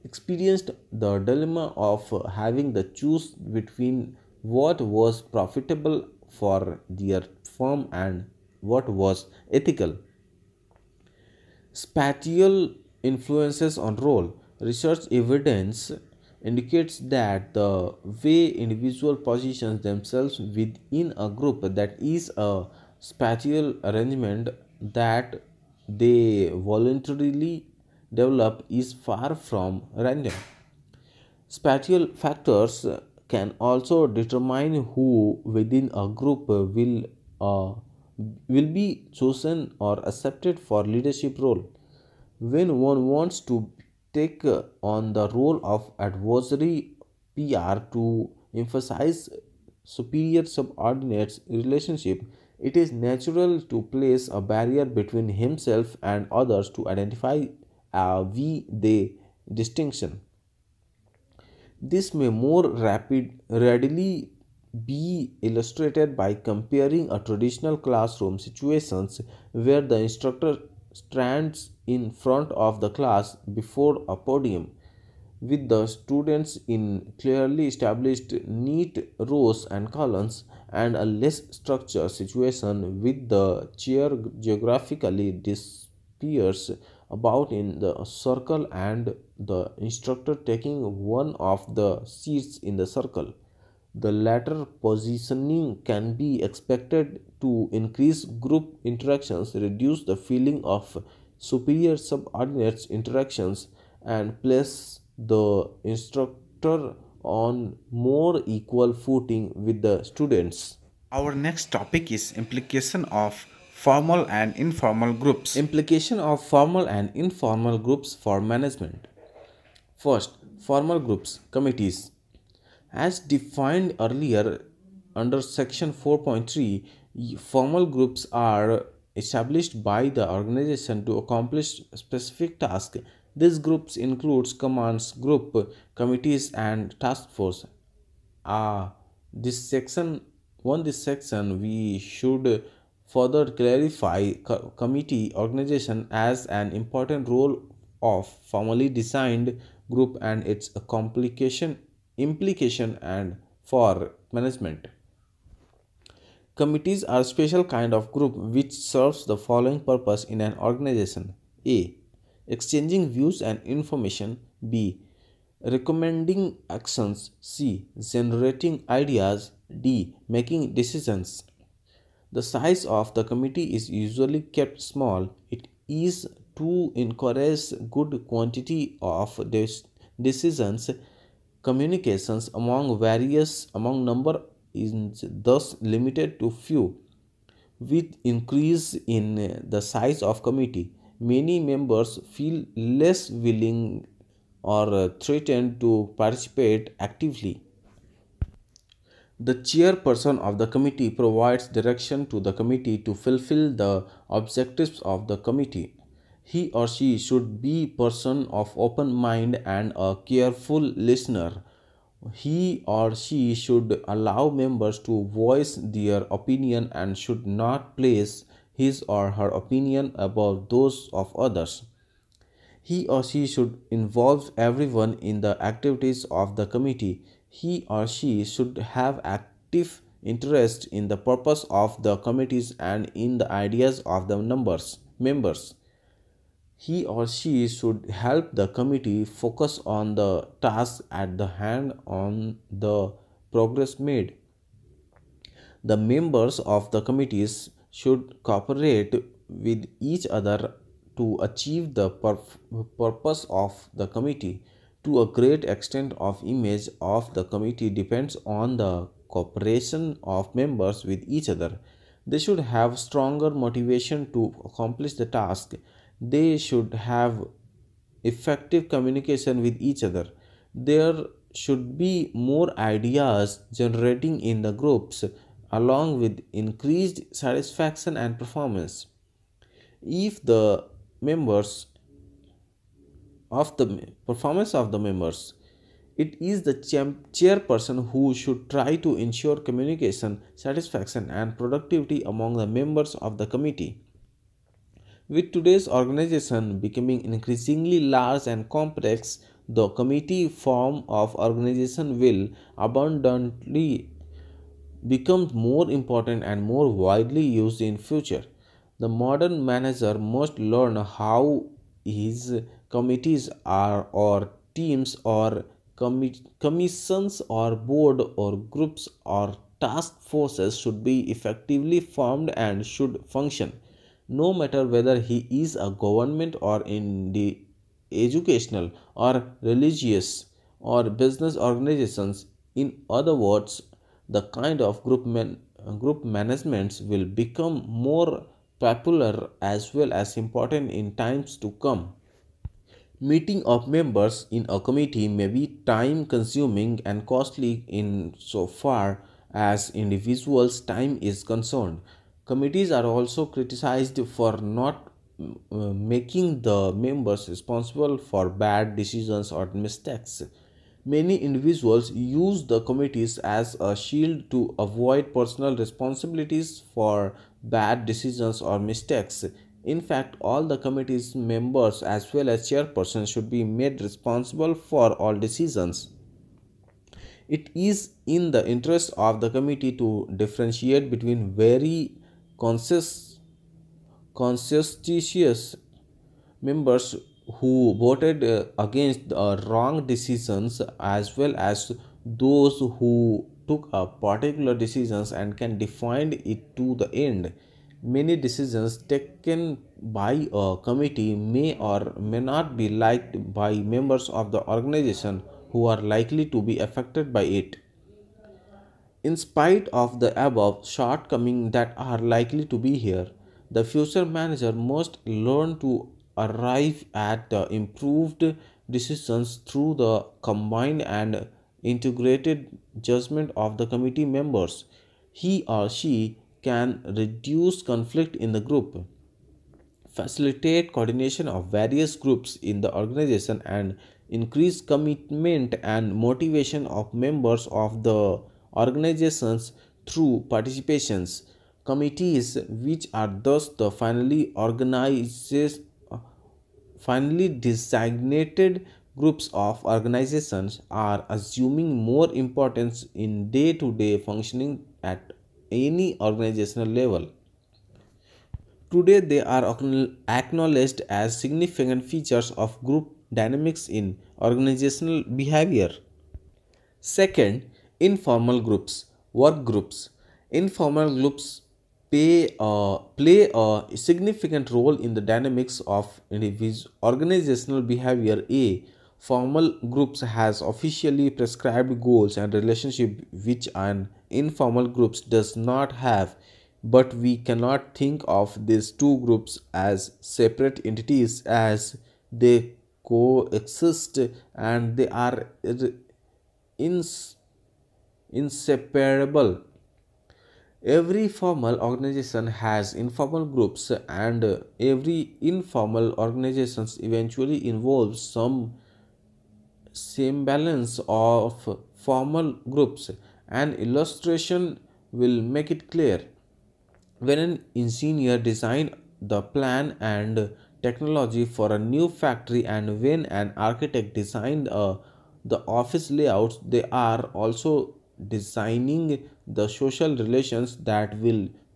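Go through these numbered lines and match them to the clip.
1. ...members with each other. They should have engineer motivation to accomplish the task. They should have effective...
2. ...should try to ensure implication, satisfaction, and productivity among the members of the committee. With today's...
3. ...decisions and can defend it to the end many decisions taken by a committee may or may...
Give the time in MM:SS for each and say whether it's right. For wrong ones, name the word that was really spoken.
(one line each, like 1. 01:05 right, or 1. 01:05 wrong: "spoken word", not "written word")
1. 04:20 wrong: "stronger", not "engineer"
2. 04:48 wrong: "communication", not "implication"
3. 06:34 right.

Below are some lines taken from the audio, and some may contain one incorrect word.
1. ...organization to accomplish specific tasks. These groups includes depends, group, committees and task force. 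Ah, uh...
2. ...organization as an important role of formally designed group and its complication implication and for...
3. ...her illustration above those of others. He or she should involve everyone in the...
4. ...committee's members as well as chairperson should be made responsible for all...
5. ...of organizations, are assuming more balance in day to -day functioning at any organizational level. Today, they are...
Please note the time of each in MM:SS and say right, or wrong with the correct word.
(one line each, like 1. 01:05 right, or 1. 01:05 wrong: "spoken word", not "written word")
1. 02:10 wrong: "commands", not "depends"
2. 02:25 right
3. 03:39 wrong: "opinion", not "illustration"
4. 06:10 right
5. 07:29 wrong: "importance", not "balance".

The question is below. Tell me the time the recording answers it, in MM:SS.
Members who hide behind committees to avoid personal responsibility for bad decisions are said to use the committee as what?
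06:03.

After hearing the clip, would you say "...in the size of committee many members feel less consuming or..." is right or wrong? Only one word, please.
wrong.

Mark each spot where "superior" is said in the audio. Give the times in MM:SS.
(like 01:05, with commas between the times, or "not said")
00:49, 01:41.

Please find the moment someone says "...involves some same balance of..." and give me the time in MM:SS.
08:27.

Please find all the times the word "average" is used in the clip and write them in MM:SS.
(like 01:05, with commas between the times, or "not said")
not said.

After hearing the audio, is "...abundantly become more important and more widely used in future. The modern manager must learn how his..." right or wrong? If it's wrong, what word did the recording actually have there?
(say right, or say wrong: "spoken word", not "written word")
right.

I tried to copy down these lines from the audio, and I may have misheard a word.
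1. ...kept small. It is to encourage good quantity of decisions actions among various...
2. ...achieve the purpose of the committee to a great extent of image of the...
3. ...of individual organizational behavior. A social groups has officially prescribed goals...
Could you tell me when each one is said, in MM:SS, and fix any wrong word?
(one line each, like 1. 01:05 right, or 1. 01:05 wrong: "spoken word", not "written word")
1. 02:54 wrong: "communications", not "actions"
2. 04:11 right
3. 07:55 wrong: "formal", not "social".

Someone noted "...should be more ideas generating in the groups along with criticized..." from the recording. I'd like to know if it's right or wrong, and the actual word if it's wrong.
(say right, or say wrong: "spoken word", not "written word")
wrong: "increased", not "criticized".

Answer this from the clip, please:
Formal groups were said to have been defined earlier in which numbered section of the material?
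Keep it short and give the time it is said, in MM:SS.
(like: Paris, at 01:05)
4.3, at 02:05.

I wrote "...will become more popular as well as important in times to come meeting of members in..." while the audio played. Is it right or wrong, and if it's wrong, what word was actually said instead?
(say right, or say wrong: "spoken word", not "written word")
right.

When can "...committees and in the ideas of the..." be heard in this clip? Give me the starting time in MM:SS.
03:52.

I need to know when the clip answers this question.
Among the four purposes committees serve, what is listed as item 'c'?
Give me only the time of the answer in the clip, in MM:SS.
02:48.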